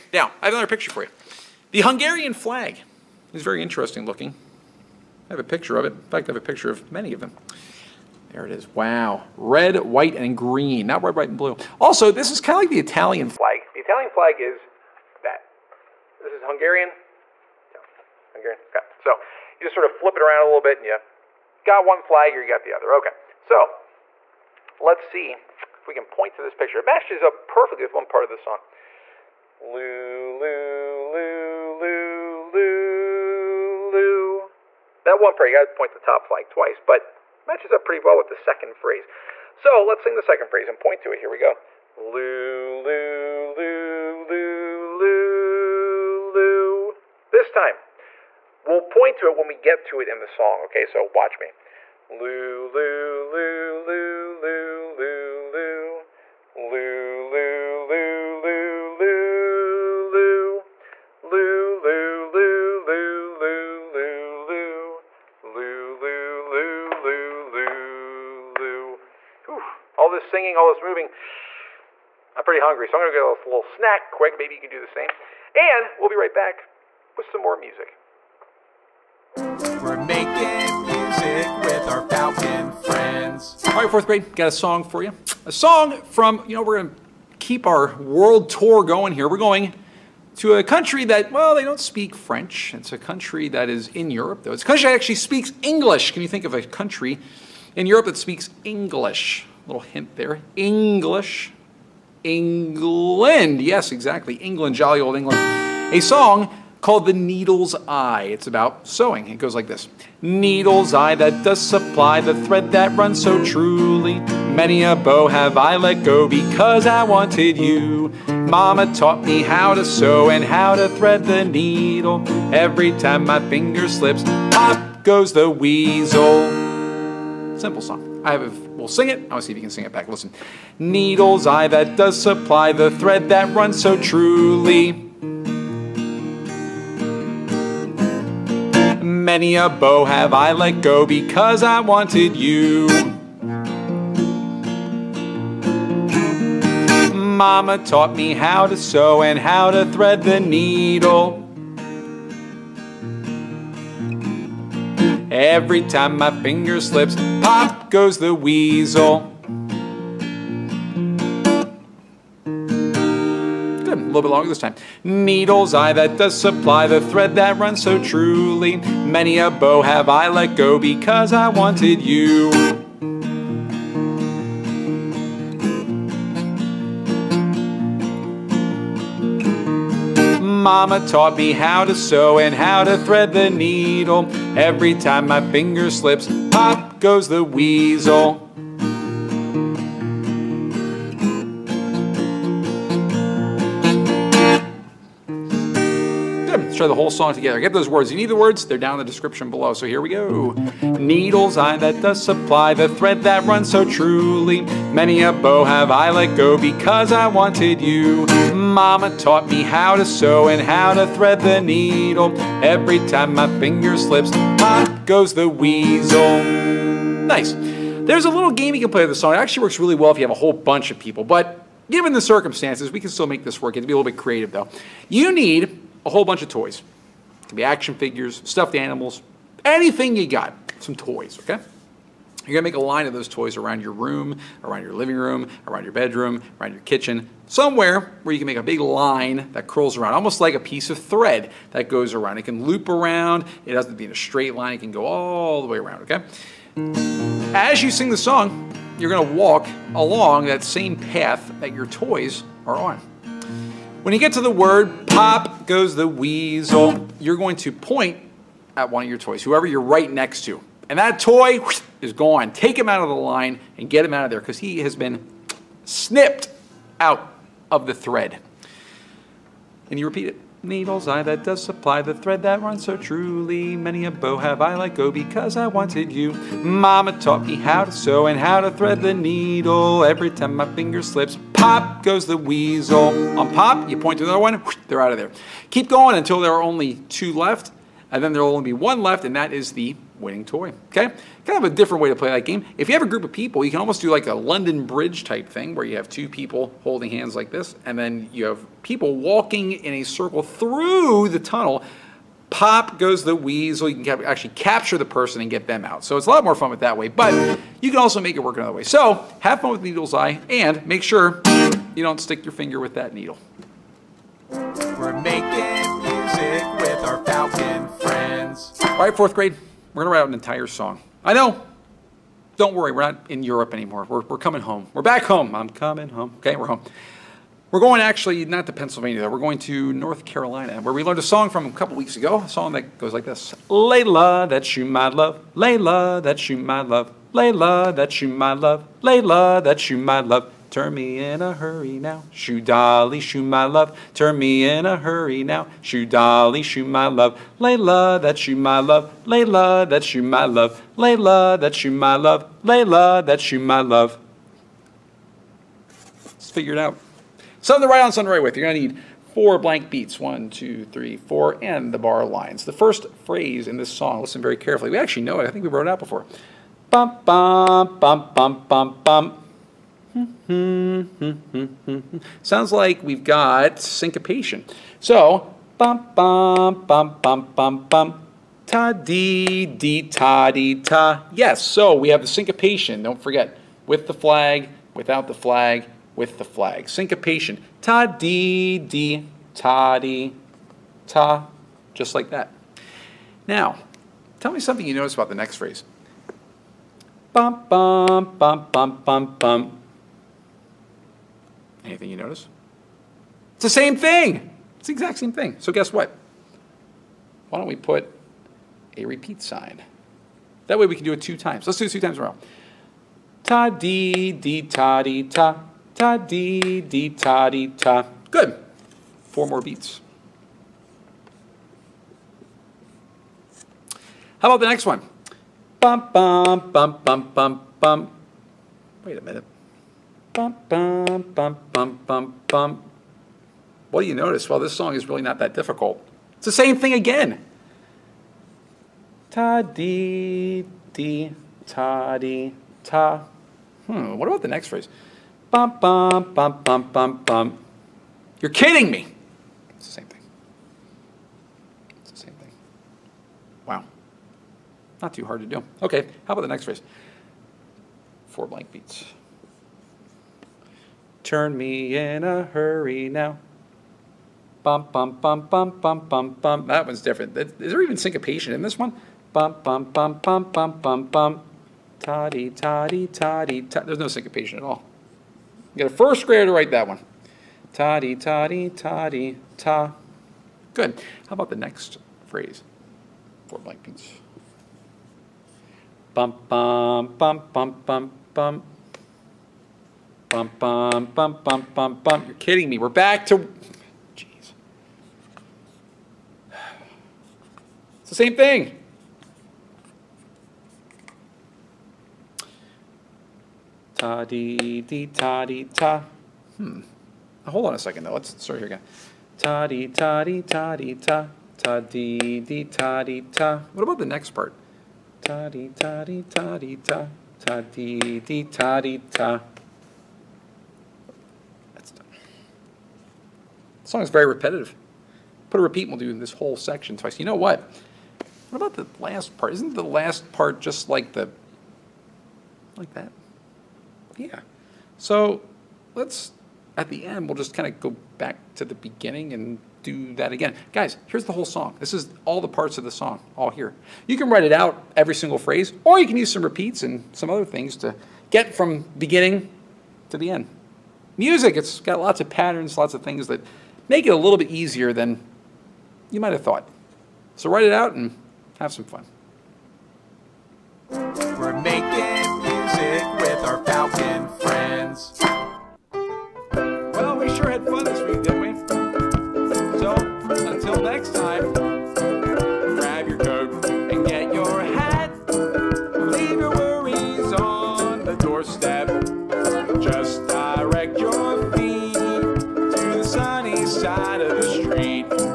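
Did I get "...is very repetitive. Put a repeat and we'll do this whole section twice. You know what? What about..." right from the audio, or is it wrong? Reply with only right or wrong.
right.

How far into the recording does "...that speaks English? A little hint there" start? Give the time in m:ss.
1:38.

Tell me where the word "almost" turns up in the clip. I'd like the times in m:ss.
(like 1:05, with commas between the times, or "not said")
4:00, 4:53.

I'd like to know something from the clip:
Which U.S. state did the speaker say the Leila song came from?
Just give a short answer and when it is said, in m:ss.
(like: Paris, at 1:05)
North Carolina, at 5:29.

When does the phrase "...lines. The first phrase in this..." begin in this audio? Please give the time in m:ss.
6:02.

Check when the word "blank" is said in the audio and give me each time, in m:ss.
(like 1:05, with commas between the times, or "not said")
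5:59, 7:38, 8:03.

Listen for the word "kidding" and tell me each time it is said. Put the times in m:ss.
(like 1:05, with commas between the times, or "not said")
7:28, 8:12.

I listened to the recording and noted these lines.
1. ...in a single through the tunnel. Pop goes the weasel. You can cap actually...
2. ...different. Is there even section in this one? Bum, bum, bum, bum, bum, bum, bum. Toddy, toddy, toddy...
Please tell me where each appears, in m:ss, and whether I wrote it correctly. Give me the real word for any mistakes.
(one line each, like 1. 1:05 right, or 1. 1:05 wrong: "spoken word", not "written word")
1. 4:59 wrong: "circle", not "single"
2. 7:46 wrong: "syncopation", not "section".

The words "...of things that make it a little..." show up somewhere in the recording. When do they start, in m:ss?
9:12.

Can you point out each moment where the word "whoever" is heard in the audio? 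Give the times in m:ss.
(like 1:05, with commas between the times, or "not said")
4:19.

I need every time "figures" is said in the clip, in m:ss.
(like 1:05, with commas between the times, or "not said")
3:47, 5:56.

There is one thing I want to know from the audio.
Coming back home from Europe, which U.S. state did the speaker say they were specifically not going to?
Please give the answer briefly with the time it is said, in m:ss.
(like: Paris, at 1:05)
Pennsylvania, at 5:28.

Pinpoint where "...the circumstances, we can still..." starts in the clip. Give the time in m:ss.
3:42.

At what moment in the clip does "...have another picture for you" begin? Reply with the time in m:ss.
0:00.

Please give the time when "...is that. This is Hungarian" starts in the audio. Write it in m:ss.
0:14.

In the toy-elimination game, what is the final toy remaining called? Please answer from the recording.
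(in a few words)
the winning toy.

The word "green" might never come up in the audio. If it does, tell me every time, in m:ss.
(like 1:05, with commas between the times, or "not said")
0:10.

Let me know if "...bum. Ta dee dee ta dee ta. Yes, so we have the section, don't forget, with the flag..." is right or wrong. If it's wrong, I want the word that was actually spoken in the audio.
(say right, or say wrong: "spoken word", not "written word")
wrong: "syncopation", not "section".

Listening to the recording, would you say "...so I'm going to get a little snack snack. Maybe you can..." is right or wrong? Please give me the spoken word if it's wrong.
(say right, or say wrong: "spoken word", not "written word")
wrong: "quick", not "snack".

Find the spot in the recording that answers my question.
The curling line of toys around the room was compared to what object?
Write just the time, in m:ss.
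4:00.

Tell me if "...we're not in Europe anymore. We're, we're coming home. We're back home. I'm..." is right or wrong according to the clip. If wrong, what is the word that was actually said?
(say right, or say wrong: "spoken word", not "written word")
right.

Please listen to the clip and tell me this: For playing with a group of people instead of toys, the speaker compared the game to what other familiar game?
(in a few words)
London Bridge.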